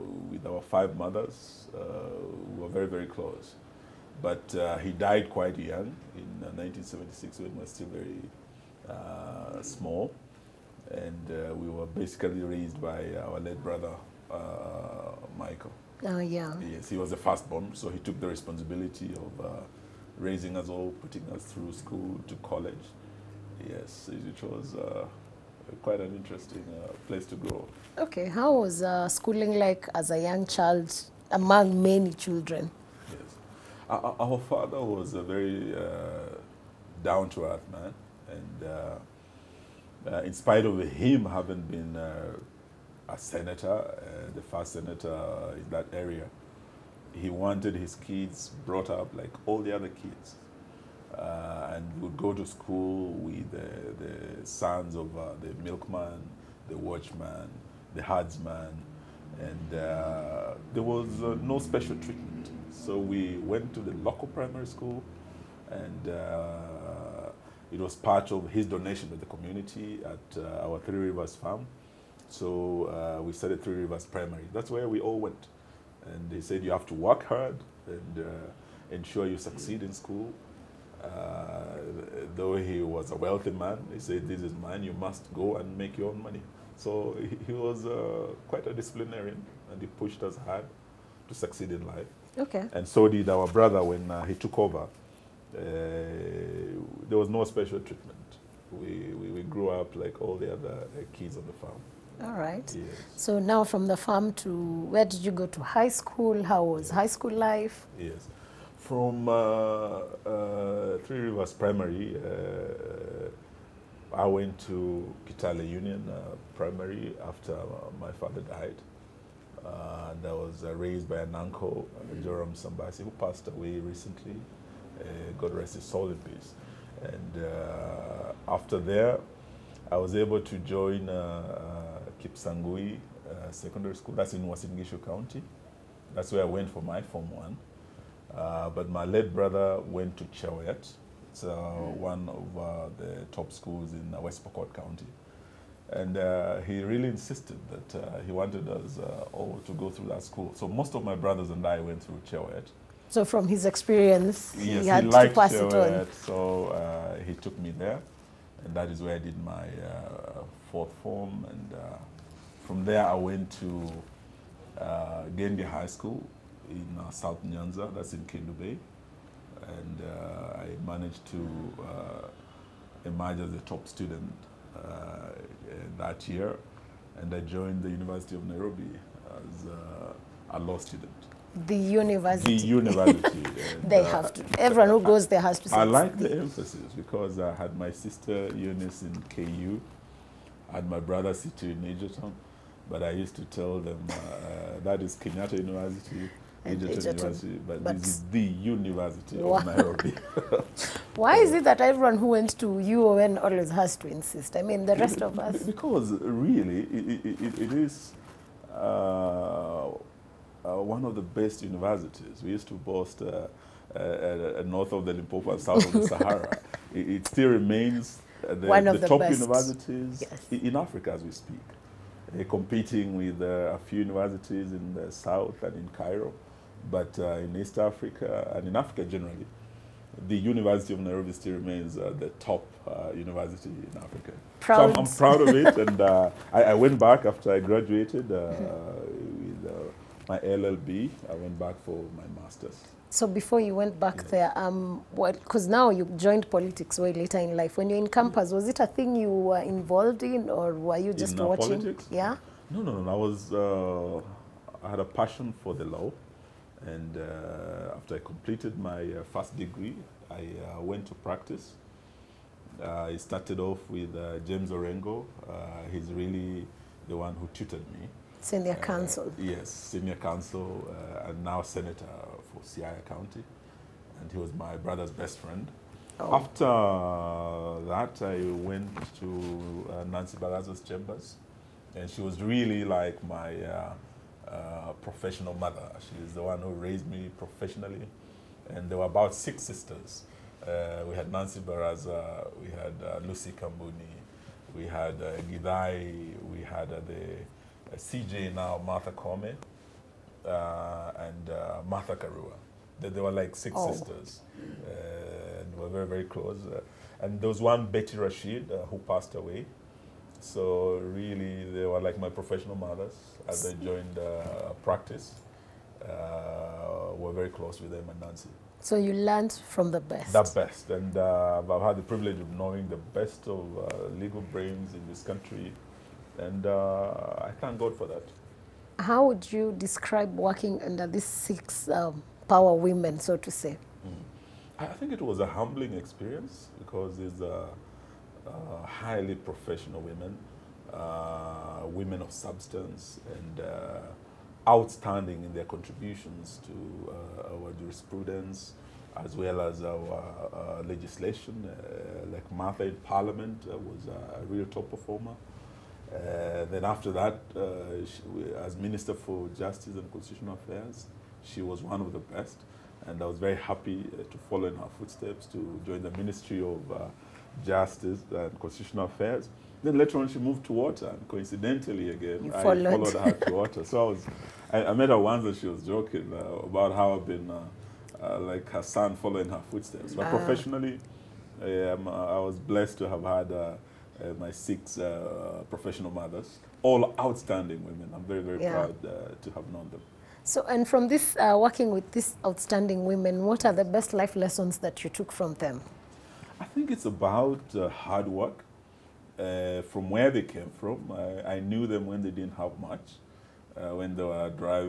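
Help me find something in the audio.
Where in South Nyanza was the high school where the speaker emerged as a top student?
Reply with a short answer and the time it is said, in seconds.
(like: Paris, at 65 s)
Kendu Bay, at 168 s.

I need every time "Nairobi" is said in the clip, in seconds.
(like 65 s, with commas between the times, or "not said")
178 s, 199 s, 230 s.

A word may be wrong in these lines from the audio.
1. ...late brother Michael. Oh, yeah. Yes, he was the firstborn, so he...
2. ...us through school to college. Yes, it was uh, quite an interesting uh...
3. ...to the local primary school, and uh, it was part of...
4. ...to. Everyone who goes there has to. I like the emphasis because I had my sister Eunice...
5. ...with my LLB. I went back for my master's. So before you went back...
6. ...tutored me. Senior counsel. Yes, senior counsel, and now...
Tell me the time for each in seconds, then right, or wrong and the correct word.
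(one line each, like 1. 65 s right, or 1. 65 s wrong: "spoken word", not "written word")
1. 13 s right
2. 21 s right
3. 63 s right
4. 184 s right
5. 238 s right
6. 267 s right.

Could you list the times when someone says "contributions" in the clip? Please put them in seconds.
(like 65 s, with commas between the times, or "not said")
345 s.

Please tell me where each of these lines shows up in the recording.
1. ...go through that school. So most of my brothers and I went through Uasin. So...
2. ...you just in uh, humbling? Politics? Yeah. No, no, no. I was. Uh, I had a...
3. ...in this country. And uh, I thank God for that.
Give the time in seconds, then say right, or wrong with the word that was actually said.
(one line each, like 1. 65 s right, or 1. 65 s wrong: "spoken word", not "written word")
1. 149 s wrong: "Chewoyet", not "Uasin"
2. 250 s wrong: "watching", not "humbling"
3. 324 s right.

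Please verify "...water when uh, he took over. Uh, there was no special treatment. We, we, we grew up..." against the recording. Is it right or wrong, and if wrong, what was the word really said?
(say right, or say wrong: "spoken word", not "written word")
wrong: "brother", not "water".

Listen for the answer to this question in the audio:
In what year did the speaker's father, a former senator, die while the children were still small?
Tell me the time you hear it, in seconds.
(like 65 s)
6 s.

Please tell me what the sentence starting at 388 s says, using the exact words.
proud uh, to have known them.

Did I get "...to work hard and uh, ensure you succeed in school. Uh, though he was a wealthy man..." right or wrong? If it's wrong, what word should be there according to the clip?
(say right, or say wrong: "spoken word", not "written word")
right.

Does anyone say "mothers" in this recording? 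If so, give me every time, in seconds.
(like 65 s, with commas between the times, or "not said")
0 s, 285 s, 312 s, 386 s.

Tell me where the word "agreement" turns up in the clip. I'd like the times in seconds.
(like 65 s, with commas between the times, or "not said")
not said.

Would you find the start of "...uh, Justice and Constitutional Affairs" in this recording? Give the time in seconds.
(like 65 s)
366 s.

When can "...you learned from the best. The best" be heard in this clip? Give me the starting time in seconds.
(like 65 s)
318 s.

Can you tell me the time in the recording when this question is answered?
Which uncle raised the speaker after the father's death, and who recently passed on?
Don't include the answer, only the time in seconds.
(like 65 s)
122 s.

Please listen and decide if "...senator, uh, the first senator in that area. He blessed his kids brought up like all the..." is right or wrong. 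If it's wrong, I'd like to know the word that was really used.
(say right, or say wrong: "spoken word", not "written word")
wrong: "wanted", not "blessed".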